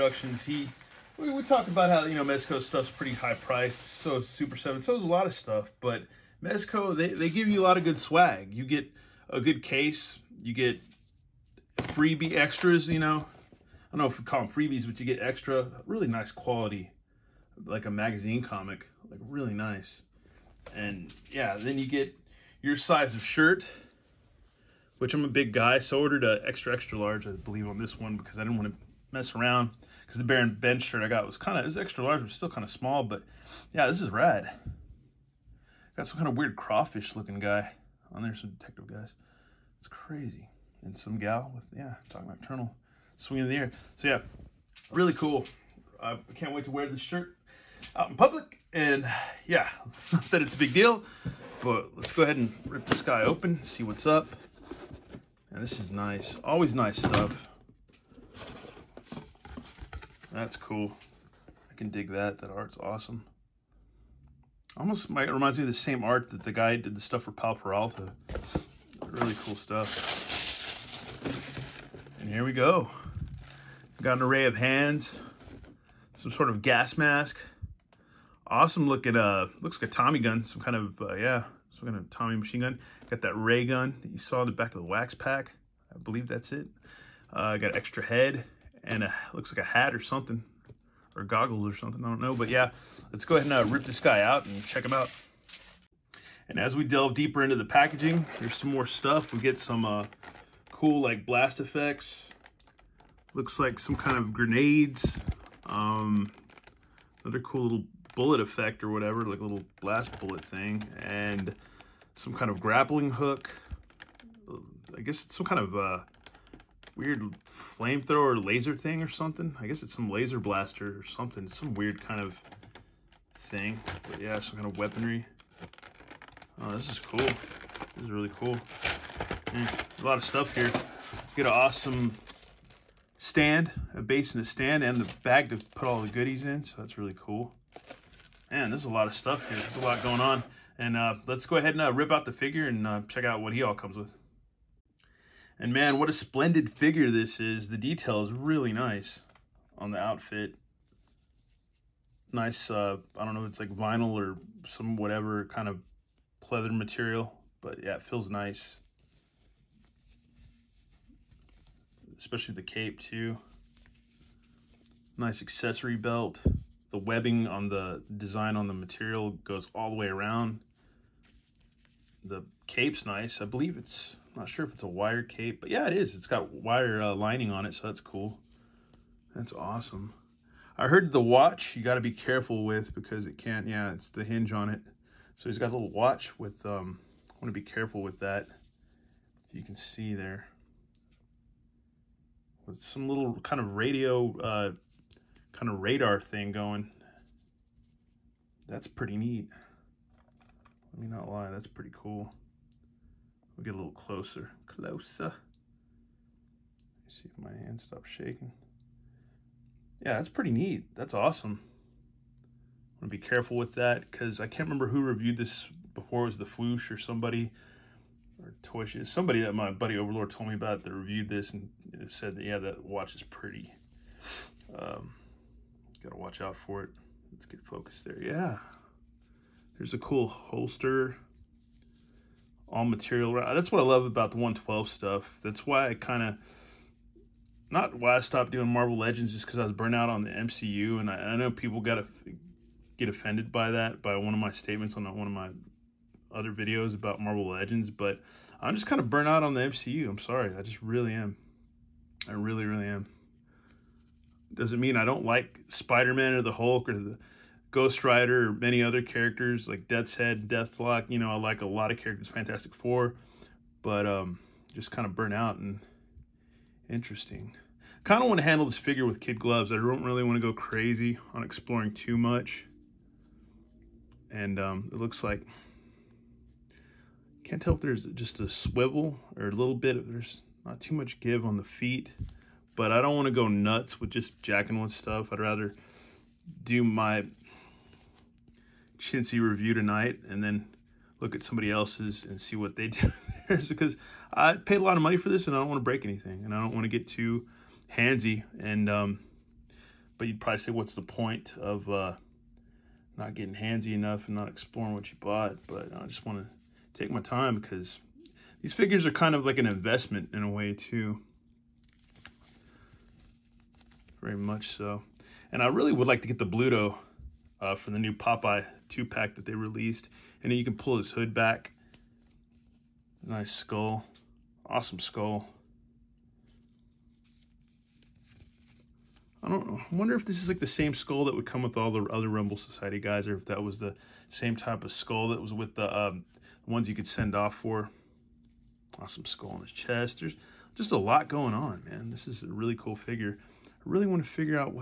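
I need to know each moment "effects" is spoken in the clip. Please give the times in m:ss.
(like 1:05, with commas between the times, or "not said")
1:41, 1:48.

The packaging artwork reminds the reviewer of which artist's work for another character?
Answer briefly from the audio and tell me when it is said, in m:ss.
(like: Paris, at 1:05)
Pal Peralta, at 1:07.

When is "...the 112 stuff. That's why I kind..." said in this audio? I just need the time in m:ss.
3:54.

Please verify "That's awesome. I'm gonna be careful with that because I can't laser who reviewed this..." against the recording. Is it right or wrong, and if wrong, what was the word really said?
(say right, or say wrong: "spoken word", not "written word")
wrong: "remember", not "laser".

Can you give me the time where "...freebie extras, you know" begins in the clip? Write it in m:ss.
0:11.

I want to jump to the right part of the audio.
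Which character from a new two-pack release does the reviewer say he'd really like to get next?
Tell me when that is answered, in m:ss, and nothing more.
5:16.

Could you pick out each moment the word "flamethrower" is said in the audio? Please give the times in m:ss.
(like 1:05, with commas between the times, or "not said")
1:57.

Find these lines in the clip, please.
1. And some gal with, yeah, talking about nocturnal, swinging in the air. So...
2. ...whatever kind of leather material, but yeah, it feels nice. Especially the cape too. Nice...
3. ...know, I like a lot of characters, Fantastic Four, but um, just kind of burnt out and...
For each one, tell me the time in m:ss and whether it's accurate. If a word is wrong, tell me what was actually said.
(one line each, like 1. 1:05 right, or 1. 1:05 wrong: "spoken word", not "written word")
1. 0:40 right
2. 2:34 right
3. 4:21 right.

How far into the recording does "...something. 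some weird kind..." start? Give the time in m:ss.
2:01.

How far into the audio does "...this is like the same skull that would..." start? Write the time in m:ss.
5:30.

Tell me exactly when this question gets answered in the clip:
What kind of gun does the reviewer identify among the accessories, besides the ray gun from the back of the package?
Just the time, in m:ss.
1:19.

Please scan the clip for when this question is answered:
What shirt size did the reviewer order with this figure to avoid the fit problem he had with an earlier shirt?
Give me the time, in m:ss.
0:26.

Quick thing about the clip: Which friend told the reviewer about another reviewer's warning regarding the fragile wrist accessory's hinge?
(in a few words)
Overlord.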